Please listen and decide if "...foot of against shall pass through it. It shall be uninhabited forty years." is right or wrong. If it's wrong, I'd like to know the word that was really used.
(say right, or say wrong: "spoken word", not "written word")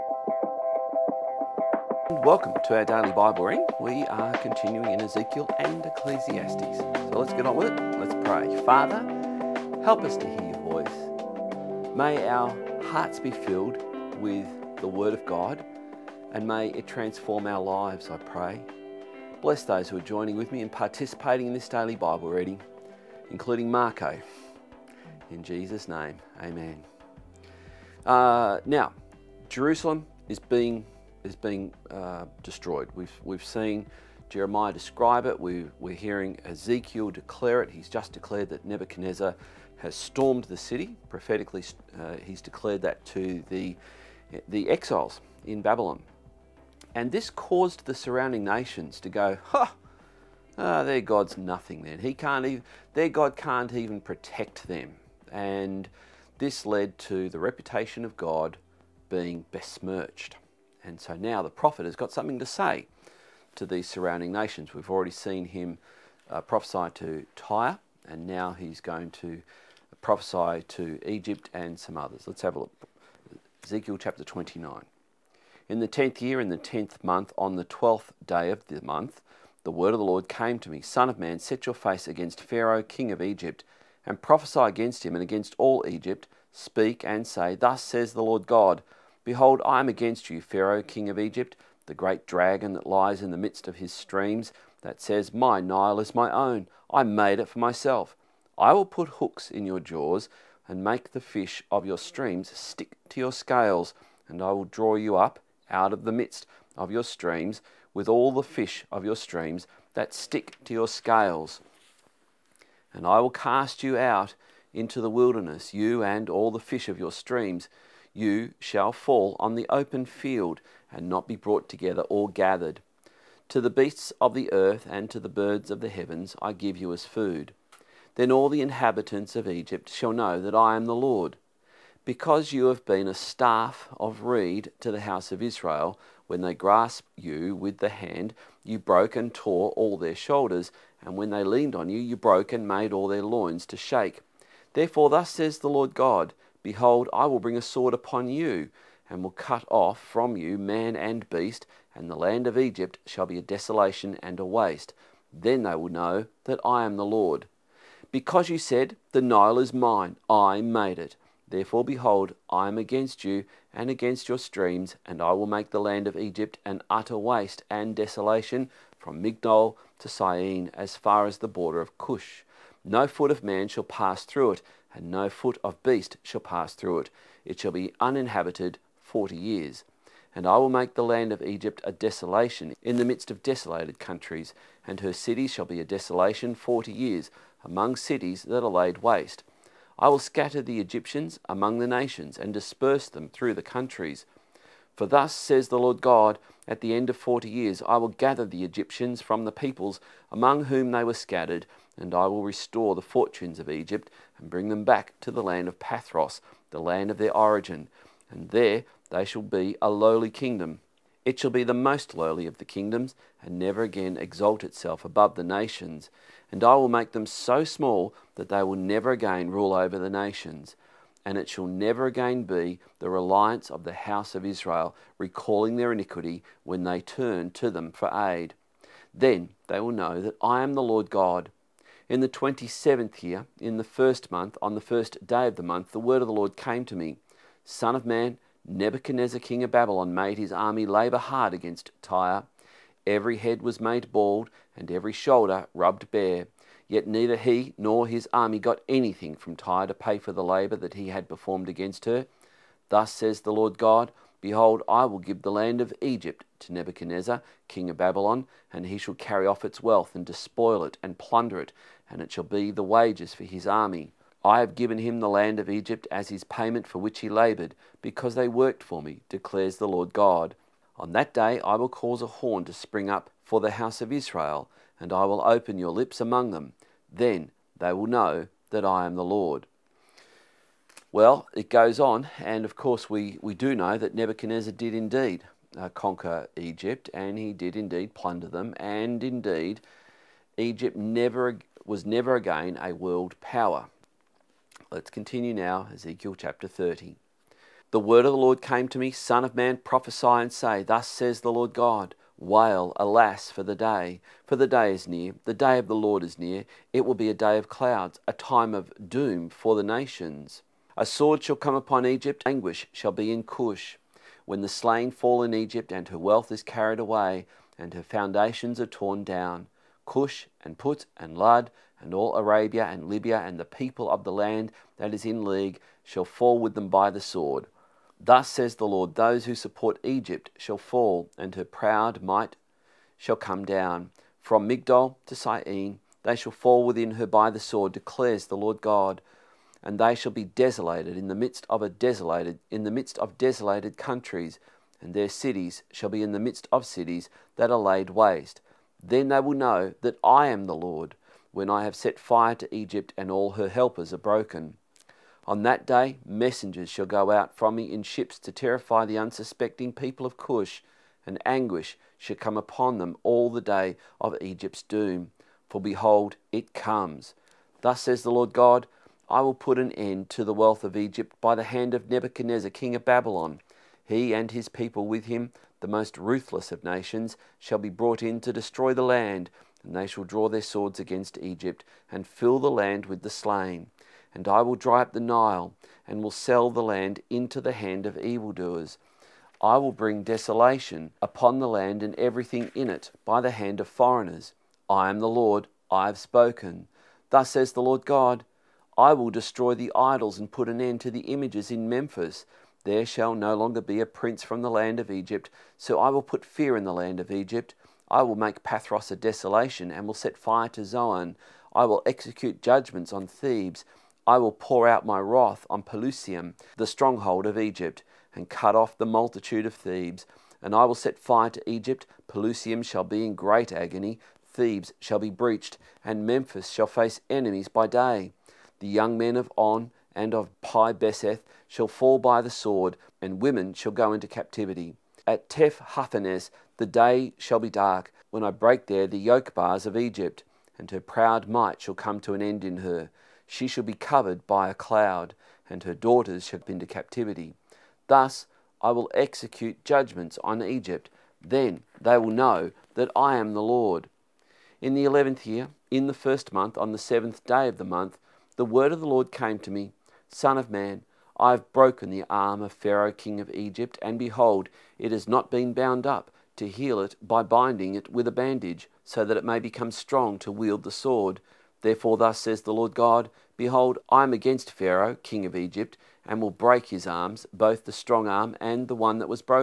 wrong: "beast", not "against".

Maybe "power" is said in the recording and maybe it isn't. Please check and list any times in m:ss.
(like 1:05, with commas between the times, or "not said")
4:53.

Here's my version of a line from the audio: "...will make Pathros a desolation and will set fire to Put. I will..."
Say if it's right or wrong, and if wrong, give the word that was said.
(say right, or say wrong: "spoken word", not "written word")
wrong: "Zoan", not "Put".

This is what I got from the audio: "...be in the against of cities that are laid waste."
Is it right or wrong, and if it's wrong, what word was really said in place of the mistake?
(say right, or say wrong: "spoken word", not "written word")
wrong: "midst", not "against".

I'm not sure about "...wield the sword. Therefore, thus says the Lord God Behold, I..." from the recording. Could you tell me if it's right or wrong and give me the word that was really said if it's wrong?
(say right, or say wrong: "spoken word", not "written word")
right.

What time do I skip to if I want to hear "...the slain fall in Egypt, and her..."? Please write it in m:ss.
5:14.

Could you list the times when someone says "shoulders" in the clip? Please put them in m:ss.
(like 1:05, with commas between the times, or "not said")
2:20, 4:05.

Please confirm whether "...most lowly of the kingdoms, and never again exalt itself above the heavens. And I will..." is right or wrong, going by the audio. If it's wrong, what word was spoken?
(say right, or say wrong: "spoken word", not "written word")
wrong: "nations", not "heavens".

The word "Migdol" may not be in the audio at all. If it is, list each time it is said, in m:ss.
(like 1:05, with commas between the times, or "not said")
2:49, 5:34.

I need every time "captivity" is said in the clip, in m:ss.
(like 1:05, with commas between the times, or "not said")
7:14, 7:26.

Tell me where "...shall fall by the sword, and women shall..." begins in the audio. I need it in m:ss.
7:11.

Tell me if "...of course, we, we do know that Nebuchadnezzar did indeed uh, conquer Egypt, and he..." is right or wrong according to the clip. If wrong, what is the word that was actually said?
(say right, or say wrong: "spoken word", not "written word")
right.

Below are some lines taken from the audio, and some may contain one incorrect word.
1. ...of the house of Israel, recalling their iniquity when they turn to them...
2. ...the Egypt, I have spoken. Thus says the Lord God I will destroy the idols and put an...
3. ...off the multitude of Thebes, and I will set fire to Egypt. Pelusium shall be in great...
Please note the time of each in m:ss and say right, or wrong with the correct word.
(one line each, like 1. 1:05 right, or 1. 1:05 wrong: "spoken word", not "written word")
1. 3:43 right
2. 6:35 wrong: "Lord", not "Egypt"
3. 6:58 right.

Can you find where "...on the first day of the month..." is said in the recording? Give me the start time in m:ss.
3:54.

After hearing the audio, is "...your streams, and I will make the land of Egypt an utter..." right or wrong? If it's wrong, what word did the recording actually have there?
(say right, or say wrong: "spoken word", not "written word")
right.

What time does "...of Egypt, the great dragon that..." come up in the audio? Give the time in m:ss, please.
1:31.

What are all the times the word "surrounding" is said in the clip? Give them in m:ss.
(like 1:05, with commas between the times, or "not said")
0:47, 1:03.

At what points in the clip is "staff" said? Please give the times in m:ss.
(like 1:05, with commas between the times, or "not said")
2:13.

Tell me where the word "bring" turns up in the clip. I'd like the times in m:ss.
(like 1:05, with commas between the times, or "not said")
2:27, 3:24, 6:29.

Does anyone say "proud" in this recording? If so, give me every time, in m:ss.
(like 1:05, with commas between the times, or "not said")
5:31, 7:21.